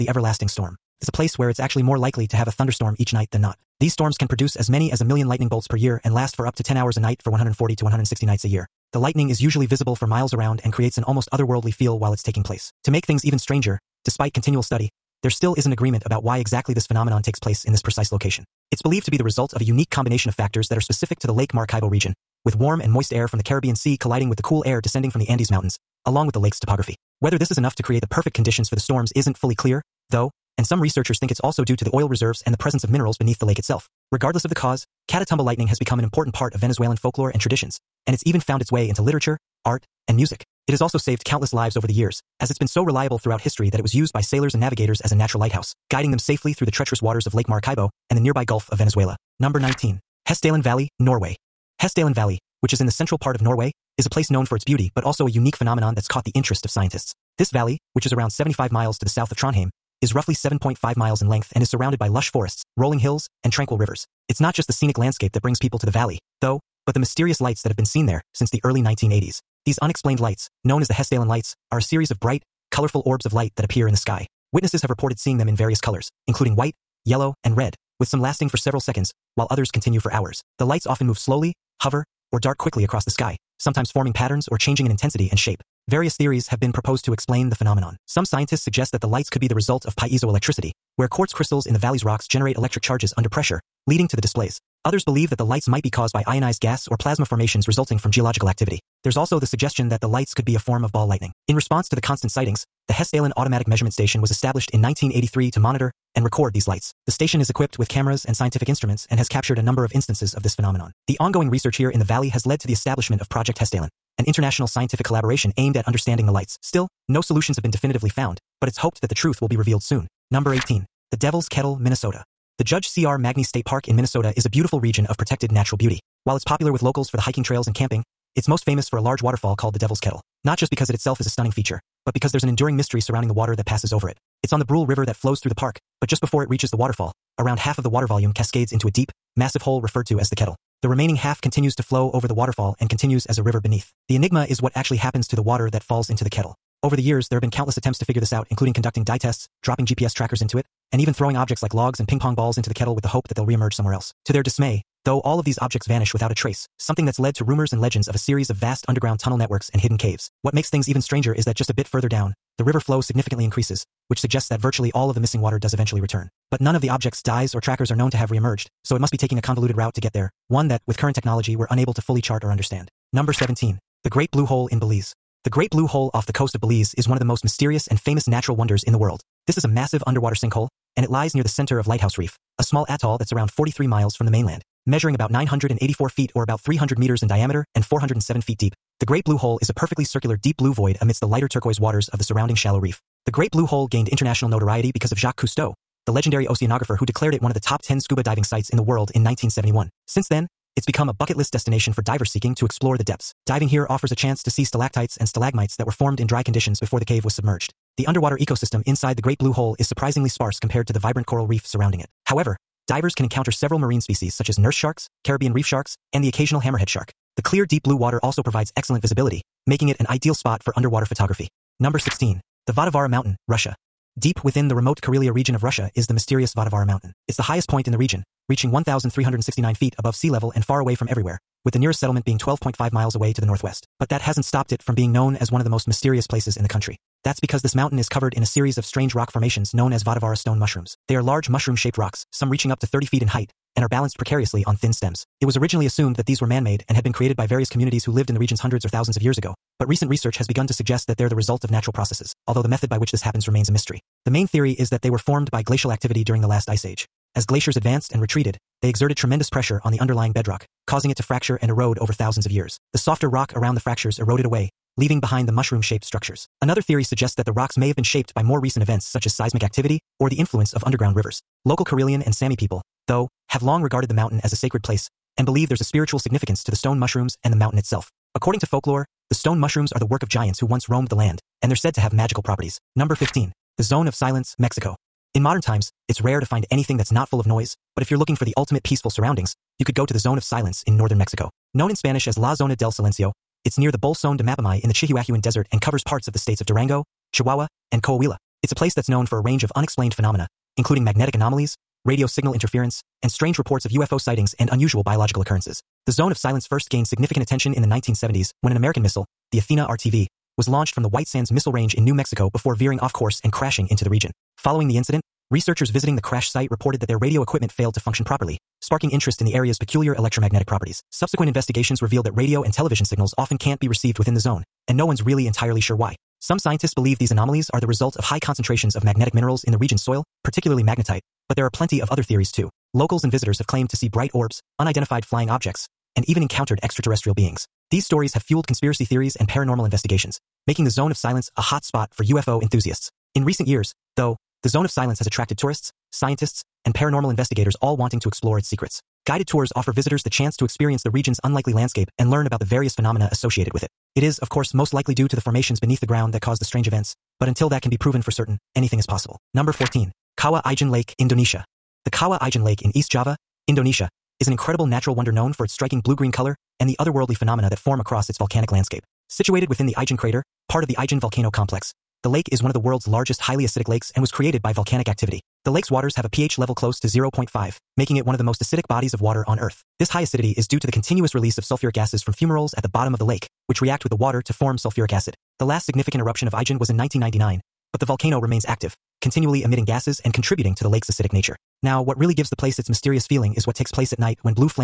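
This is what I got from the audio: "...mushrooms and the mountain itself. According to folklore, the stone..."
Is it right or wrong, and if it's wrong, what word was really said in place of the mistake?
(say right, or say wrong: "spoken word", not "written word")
right.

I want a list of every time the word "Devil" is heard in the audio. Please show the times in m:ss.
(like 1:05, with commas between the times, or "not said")
2:01, 2:09.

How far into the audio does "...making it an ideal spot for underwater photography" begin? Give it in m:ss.
3:39.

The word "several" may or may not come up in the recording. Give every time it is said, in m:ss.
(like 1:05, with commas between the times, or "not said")
1:18, 3:33.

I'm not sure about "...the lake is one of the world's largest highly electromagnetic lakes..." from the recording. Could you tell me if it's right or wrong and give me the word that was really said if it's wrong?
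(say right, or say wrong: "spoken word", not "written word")
wrong: "acidic", not "electromagnetic".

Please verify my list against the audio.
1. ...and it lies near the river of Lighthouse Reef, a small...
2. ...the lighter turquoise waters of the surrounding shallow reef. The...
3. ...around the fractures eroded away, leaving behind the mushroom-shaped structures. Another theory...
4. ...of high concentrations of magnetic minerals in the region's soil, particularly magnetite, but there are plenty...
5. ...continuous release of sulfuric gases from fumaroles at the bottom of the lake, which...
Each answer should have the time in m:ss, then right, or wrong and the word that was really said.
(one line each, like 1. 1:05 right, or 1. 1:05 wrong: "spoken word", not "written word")
1. 3:00 wrong: "center", not "river"
2. 3:11 right
3. 4:23 right
4. 5:28 right
5. 6:20 right.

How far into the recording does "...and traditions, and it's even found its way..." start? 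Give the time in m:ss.
0:37.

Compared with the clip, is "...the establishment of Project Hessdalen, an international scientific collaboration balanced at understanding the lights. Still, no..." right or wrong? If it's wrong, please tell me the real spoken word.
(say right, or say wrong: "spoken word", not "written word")
wrong: "aimed", not "balanced".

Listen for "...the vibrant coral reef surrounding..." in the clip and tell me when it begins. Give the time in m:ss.
3:30.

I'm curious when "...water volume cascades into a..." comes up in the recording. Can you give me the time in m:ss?
2:17.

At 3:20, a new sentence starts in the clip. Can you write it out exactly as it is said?
Since then, it's become a bucket list destination for divers seeking to explore the depths.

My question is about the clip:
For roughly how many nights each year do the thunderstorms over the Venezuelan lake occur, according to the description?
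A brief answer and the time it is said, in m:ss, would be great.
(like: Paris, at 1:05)
140 to 160, at 0:07.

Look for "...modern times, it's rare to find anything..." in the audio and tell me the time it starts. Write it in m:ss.
4:45.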